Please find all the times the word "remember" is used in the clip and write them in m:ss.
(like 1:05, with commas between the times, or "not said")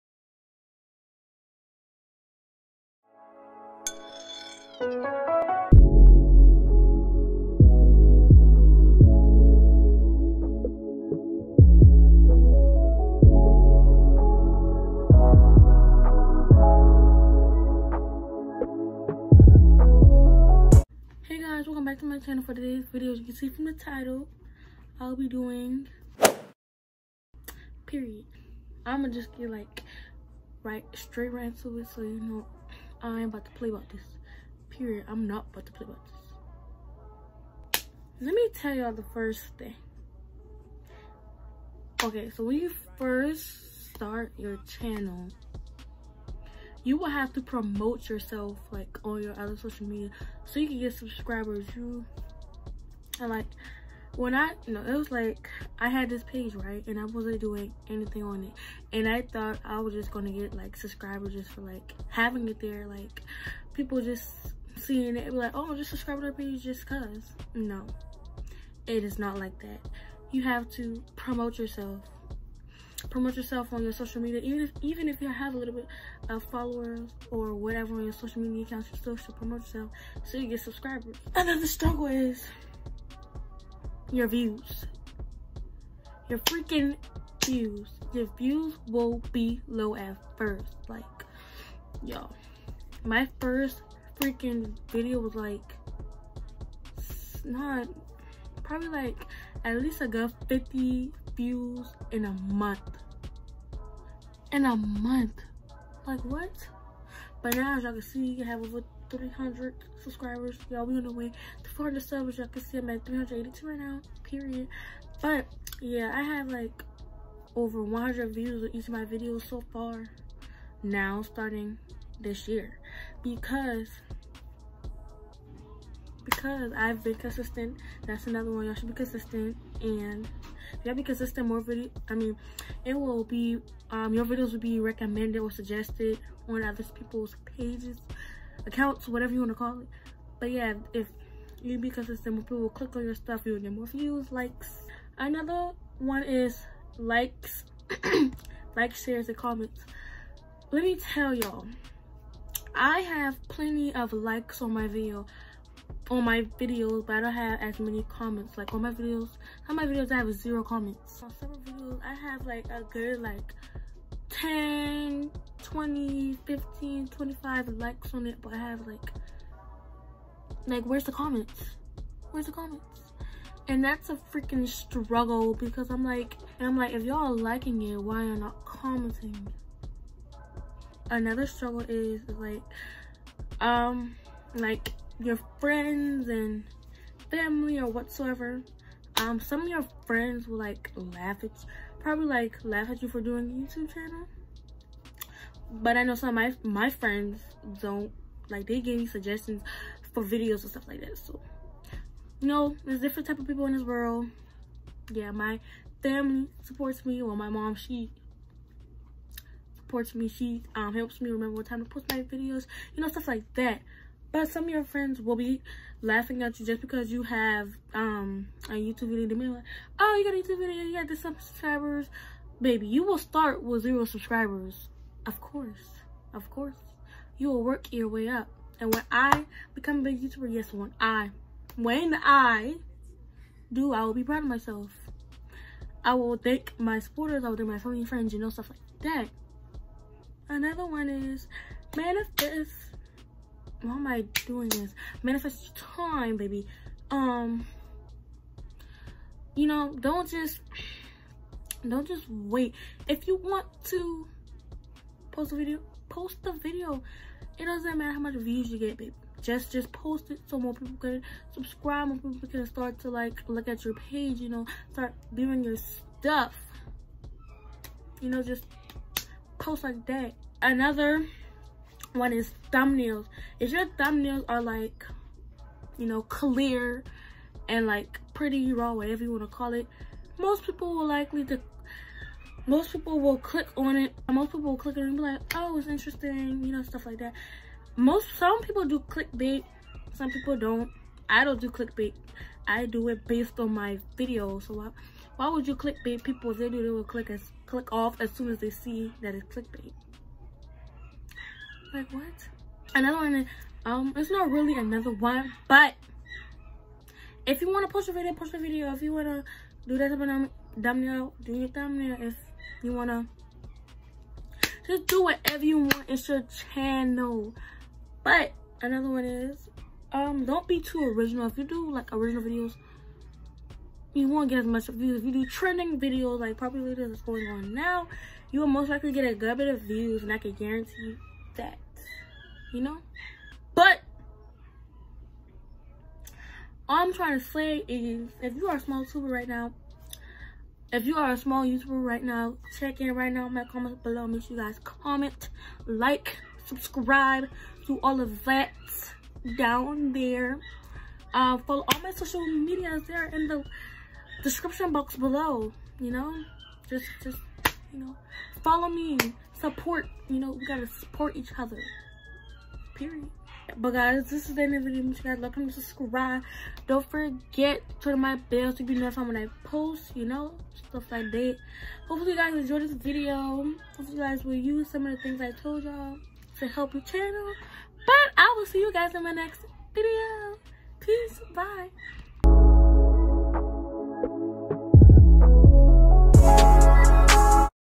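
3:31.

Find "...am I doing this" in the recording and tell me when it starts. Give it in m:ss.
4:03.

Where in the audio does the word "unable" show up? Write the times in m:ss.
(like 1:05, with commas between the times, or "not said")
not said.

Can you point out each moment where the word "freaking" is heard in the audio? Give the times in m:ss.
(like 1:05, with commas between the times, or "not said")
1:26, 1:34, 2:54.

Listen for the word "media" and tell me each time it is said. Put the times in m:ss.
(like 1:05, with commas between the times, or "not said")
0:49, 1:14, 1:18, 5:52.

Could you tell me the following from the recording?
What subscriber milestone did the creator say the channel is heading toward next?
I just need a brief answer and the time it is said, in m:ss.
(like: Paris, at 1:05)
400, at 1:51.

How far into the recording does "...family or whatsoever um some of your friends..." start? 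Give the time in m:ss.
3:07.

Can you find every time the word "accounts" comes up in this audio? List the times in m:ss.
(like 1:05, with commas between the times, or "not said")
1:18, 2:18.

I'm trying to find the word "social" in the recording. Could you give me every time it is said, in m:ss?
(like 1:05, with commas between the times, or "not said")
0:49, 1:13, 1:18, 5:52.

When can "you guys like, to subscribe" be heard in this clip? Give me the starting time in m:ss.
6:05.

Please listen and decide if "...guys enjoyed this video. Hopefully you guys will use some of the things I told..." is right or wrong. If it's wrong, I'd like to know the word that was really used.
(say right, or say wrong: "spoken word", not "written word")
right.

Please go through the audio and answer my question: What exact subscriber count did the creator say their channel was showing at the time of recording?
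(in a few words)
382.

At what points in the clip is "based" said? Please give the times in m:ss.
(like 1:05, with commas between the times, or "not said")
4:53.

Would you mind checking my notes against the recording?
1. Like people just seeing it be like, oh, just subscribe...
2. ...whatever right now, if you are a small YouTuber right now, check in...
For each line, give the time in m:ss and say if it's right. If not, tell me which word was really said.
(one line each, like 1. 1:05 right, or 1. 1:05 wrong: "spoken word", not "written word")
1. 1:02 right
2. 5:39 wrong: "tuber", not "whatever".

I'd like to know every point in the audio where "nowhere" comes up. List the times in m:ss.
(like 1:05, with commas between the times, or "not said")
not said.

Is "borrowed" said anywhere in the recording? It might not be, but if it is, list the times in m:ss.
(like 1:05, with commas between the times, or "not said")
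not said.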